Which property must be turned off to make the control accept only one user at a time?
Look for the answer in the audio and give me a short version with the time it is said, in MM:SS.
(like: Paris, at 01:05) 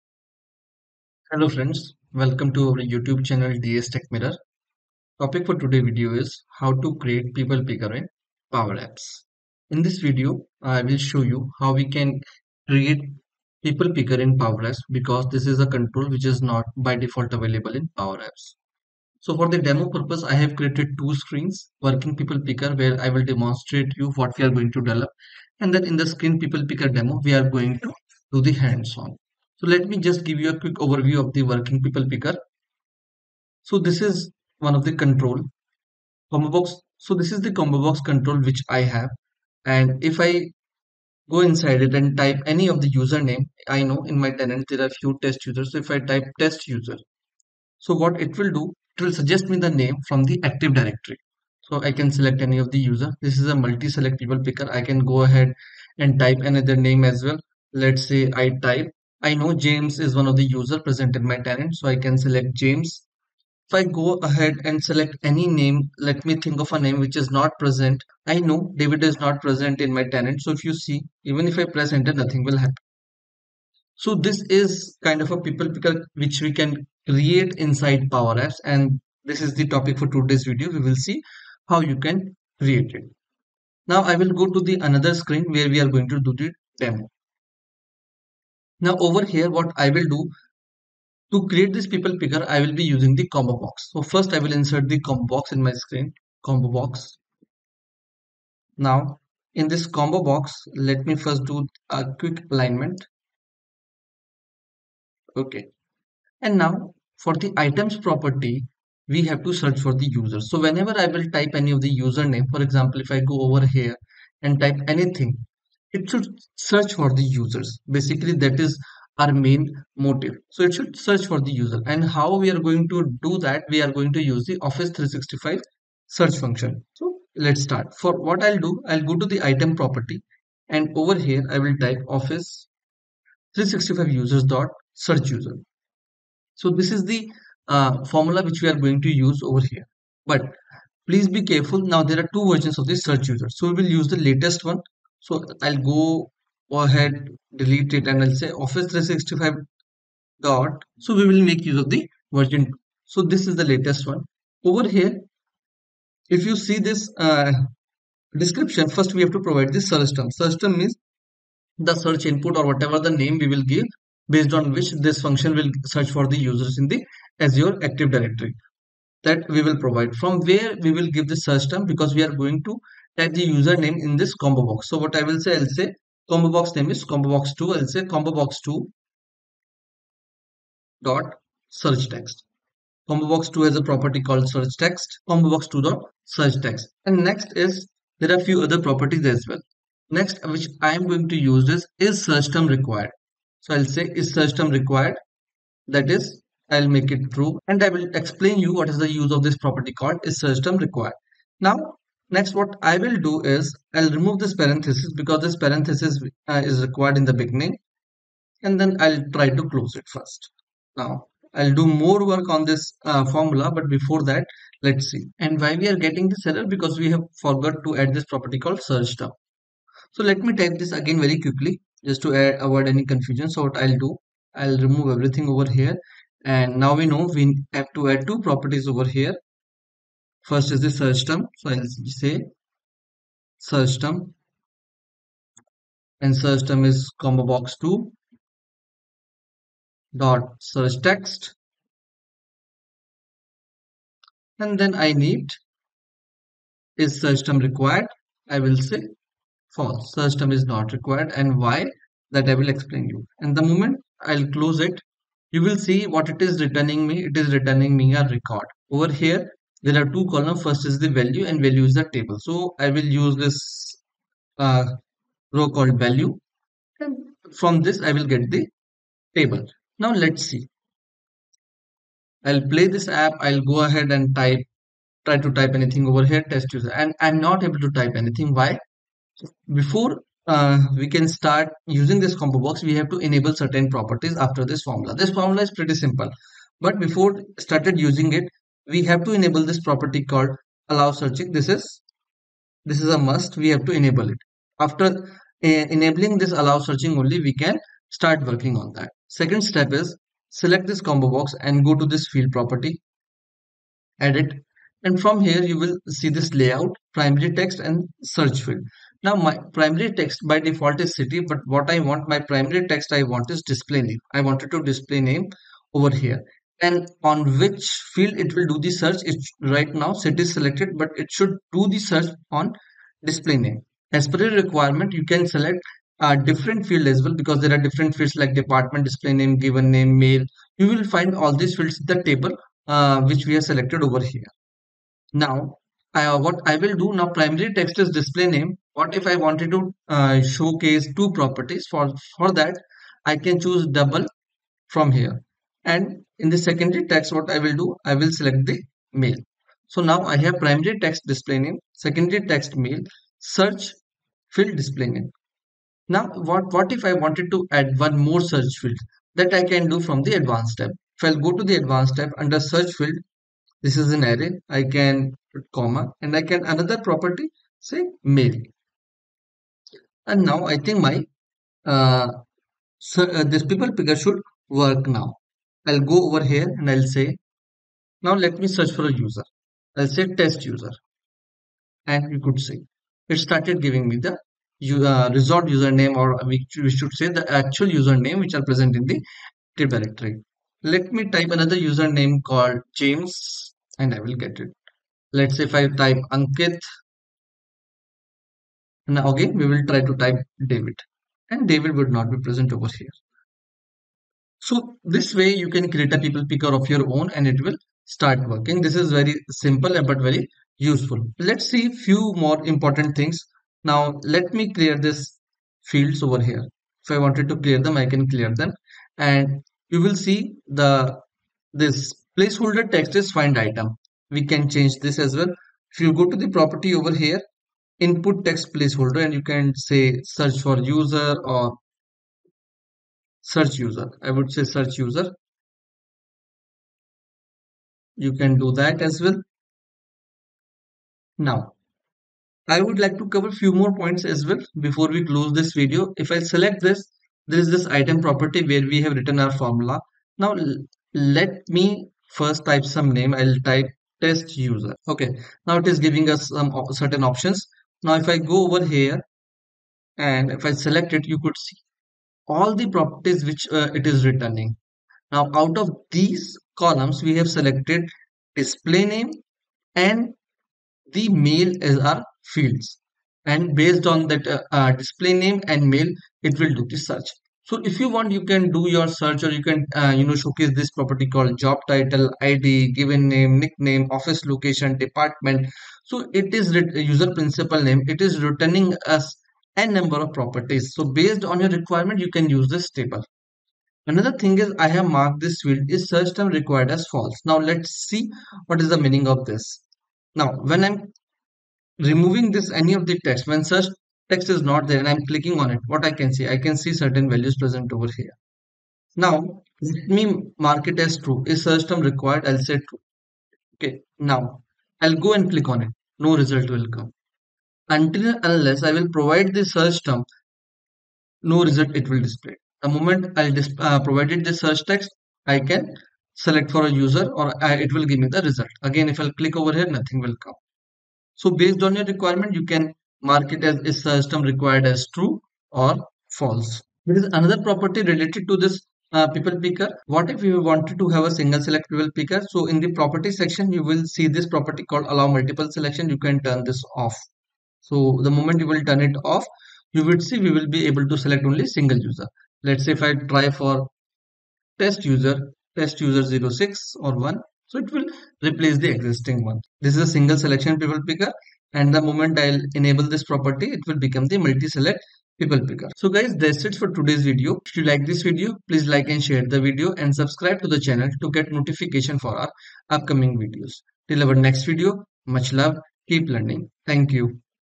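allow multiple selection, at 09:05.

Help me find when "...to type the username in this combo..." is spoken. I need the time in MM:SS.
02:52.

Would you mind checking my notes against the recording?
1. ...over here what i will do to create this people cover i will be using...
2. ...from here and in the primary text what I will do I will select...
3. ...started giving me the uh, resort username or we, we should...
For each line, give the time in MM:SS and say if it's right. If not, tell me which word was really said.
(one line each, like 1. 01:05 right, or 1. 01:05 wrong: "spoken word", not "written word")
1. 01:29 wrong: "picker", not "cover"
2. 05:44 wrong: "secondary", not "primary"
3. 06:23 right.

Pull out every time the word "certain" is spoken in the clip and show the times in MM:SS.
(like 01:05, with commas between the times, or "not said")
04:43, 07:37, 08:26.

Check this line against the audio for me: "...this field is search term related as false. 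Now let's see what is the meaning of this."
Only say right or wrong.
wrong.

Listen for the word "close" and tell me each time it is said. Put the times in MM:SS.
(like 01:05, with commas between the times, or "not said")
03:29, 04:14, 07:25.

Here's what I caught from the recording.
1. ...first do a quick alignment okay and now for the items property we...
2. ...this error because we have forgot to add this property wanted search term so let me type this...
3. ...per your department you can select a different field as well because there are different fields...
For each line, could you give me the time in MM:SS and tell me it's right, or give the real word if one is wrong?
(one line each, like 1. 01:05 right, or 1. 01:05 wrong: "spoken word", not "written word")
1. 01:41 right
2. 03:36 wrong: "called", not "wanted"
3. 05:24 wrong: "requirement", not "department".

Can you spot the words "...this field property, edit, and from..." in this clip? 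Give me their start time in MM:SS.
05:02.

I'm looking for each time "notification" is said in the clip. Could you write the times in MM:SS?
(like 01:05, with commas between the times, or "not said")
09:31.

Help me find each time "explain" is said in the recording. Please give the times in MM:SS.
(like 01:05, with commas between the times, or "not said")
03:18, 04:12.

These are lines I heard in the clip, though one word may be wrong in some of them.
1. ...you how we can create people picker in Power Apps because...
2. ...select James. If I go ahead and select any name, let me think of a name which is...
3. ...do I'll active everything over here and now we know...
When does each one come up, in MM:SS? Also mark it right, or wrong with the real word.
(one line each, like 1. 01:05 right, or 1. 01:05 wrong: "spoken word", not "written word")
1. 00:11 right
2. 01:02 right
3. 03:43 wrong: "remove", not "active".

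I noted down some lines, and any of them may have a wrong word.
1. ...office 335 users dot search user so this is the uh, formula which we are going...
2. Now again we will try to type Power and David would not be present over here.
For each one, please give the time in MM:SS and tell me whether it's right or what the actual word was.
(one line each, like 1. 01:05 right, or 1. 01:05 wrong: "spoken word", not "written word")
1. 02:12 wrong: "365", not "335"
2. 06:39 wrong: "David", not "Power".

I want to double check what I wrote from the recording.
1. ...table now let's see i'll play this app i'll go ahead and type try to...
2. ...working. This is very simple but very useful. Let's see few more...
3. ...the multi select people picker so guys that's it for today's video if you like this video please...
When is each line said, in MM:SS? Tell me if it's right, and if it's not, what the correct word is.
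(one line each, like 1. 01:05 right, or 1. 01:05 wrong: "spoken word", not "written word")
1. 04:29 right
2. 06:48 right
3. 09:24 right.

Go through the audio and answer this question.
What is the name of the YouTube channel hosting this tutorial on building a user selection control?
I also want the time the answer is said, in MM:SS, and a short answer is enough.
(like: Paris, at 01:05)
DS Tech Mirror, at 00:03.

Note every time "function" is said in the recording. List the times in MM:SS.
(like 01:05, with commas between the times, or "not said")
02:06, 02:45.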